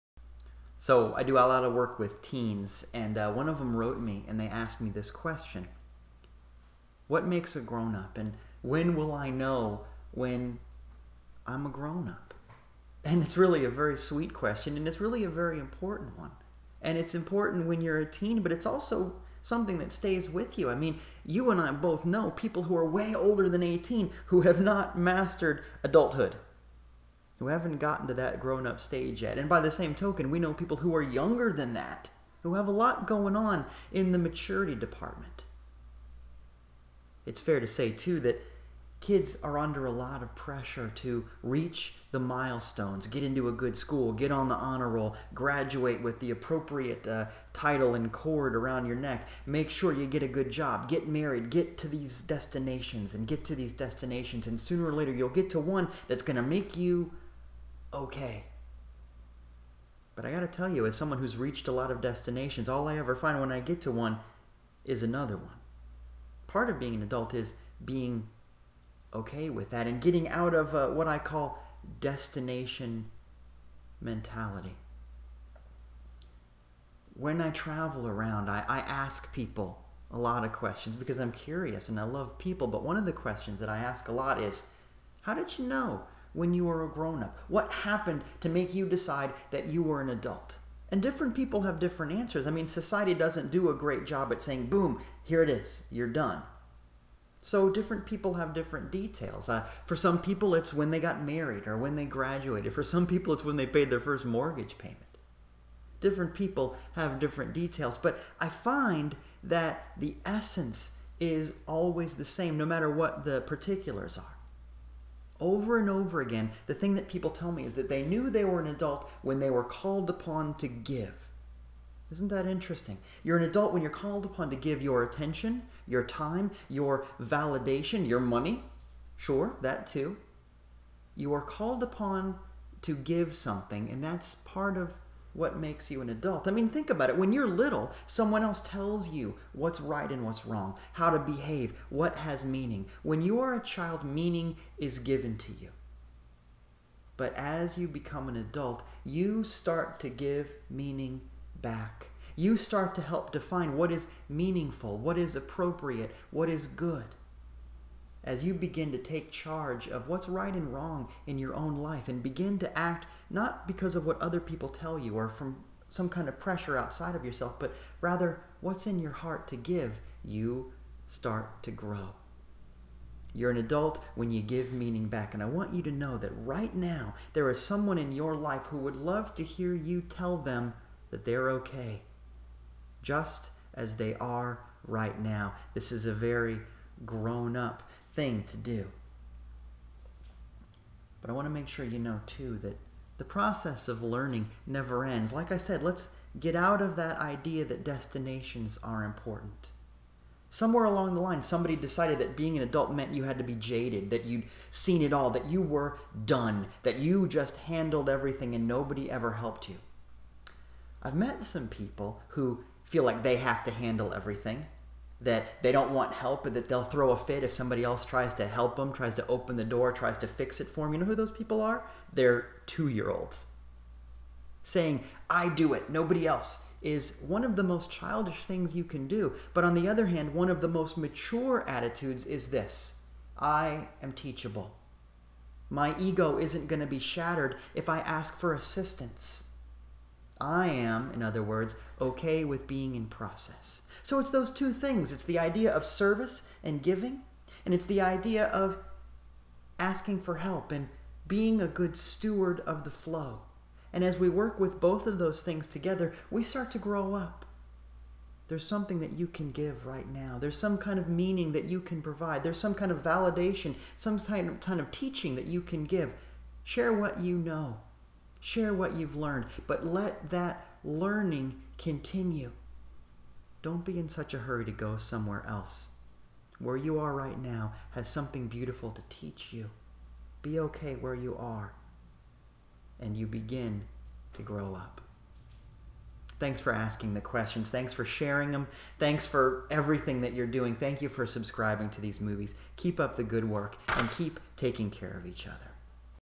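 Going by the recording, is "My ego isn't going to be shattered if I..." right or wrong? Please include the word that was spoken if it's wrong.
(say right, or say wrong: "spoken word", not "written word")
right.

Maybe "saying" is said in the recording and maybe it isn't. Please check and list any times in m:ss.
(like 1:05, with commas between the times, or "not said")
1:34, 3:44.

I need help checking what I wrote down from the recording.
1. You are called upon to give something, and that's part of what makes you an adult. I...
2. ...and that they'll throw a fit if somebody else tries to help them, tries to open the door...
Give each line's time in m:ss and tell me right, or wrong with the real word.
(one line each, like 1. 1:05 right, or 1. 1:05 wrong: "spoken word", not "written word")
1. 2:11 right
2. 3:36 right.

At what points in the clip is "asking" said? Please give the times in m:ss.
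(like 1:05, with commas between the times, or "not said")
4:09, 4:46.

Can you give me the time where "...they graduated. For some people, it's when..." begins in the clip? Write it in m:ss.
1:41.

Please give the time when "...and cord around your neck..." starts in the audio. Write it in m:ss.
0:47.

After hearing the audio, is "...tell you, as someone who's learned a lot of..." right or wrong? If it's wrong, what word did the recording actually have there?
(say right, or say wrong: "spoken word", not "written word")
wrong: "reached", not "learned".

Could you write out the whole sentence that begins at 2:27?
But as you become an adult, you start to give meaning back.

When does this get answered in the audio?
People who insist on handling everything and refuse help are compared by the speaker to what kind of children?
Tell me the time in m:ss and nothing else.
3:42.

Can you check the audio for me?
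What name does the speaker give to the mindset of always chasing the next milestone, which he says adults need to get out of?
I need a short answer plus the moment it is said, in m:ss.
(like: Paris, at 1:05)
destination mentality, at 1:11.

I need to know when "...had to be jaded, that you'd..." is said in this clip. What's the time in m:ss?
3:23.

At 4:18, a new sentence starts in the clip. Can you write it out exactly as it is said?
There's something that you can give right now.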